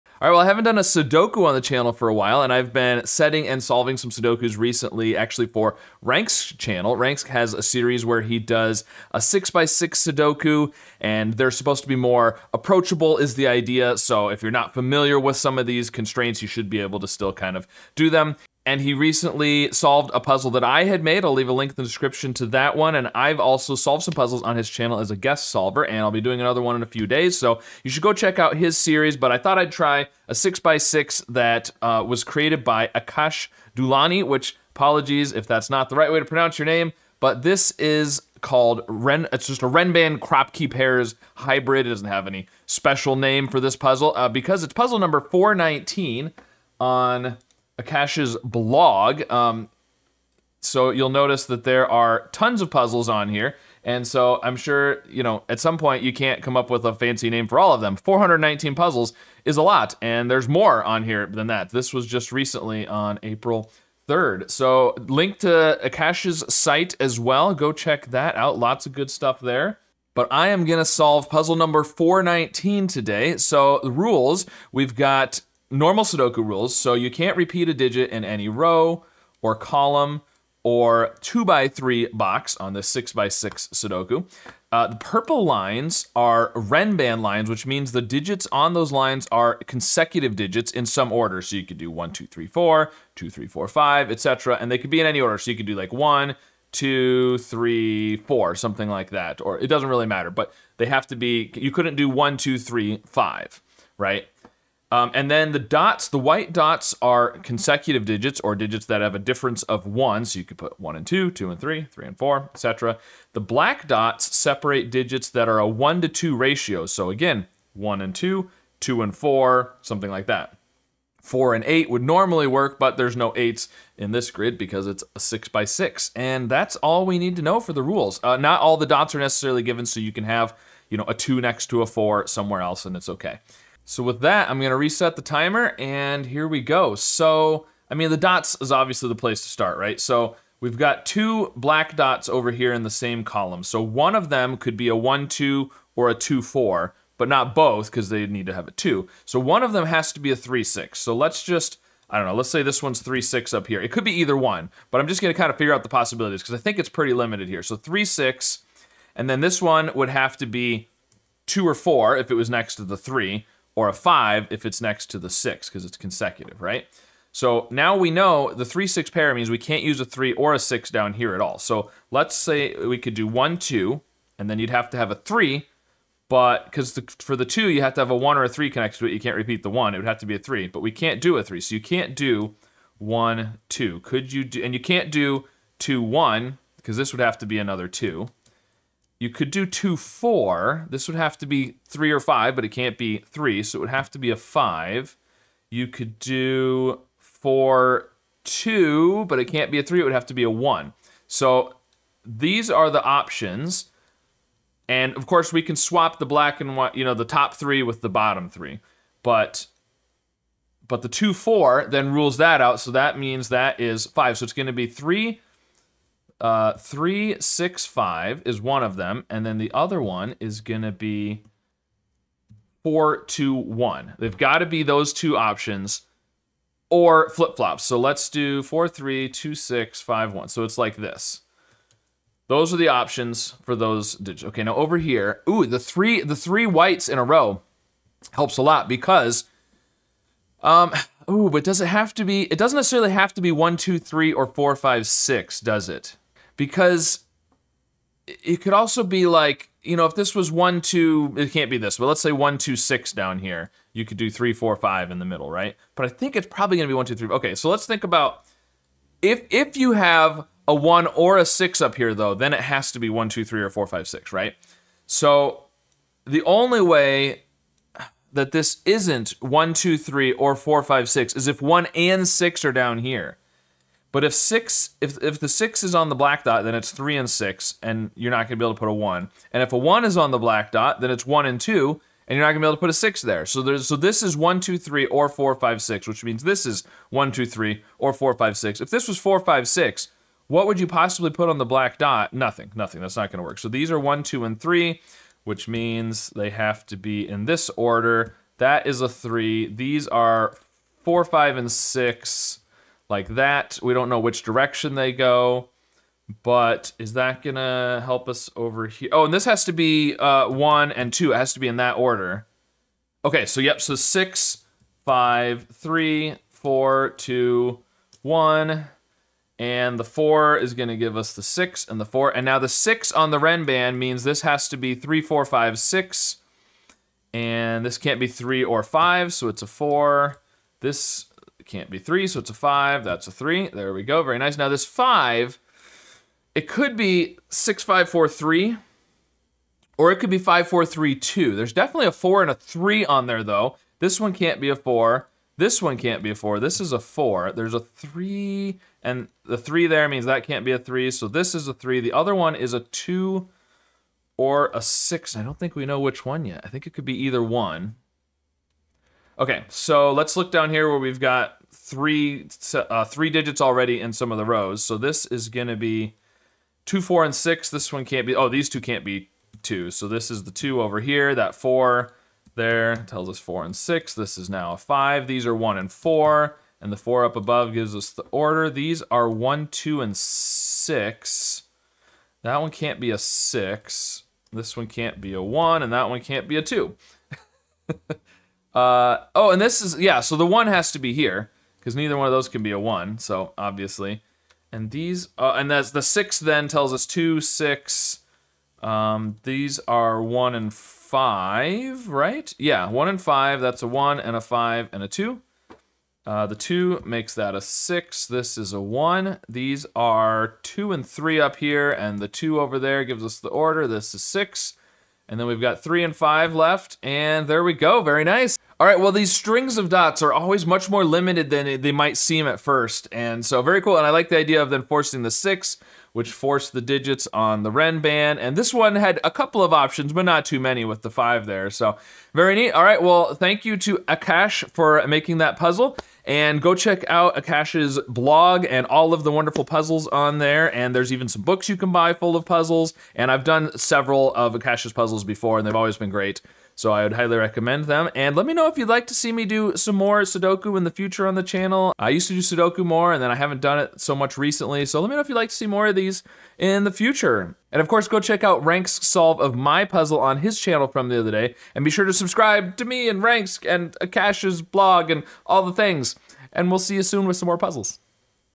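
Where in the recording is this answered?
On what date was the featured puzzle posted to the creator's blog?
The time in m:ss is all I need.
1:03.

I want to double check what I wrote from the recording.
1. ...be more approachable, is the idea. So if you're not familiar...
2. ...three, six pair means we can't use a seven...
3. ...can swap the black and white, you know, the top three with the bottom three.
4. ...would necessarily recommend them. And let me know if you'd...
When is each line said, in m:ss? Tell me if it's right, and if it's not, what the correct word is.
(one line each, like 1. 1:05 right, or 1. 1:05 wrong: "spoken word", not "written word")
1. 0:11 right
2. 2:48 wrong: "three", not "seven"
3. 3:25 right
4. 7:27 wrong: "highly", not "necessarily".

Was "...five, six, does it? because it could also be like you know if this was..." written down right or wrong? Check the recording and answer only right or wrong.
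right.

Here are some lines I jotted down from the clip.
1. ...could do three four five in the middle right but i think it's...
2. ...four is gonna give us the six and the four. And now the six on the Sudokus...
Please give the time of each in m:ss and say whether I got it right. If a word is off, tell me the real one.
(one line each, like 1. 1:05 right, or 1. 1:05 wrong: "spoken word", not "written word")
1. 4:14 right
2. 5:20 wrong: "Renban", not "Sudokus".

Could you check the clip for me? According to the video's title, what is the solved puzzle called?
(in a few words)
Ren.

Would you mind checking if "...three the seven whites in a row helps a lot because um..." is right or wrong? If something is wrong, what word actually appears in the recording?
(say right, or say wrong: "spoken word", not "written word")
wrong: "three", not "seven".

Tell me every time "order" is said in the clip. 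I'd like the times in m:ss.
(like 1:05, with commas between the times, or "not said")
1:31, 1:35, 4:57, 5:11, 6:18, 6:53.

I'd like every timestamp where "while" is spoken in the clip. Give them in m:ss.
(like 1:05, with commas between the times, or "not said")
0:02.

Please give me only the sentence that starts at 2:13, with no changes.
So with that, I'm gonna reset the timer and here we go.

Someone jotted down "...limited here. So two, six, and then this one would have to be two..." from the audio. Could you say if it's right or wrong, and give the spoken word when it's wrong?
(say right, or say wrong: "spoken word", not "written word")
wrong: "three", not "two".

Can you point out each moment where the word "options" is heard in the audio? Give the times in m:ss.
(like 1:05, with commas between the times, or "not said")
3:23, 3:45, 3:52, 7:09.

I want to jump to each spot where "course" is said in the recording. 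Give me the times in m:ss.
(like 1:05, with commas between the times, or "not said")
3:25, 7:37.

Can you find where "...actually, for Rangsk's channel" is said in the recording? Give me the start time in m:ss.
0:05.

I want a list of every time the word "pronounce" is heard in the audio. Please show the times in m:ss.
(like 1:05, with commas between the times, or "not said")
0:36.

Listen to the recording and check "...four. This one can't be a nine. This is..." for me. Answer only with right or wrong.
wrong.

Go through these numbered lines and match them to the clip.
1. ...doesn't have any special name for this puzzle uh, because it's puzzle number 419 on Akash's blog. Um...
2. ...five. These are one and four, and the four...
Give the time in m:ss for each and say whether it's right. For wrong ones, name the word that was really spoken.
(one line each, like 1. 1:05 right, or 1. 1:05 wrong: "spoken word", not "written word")
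1. 0:41 right
2. 6:14 right.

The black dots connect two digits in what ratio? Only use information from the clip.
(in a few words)
1 to 2.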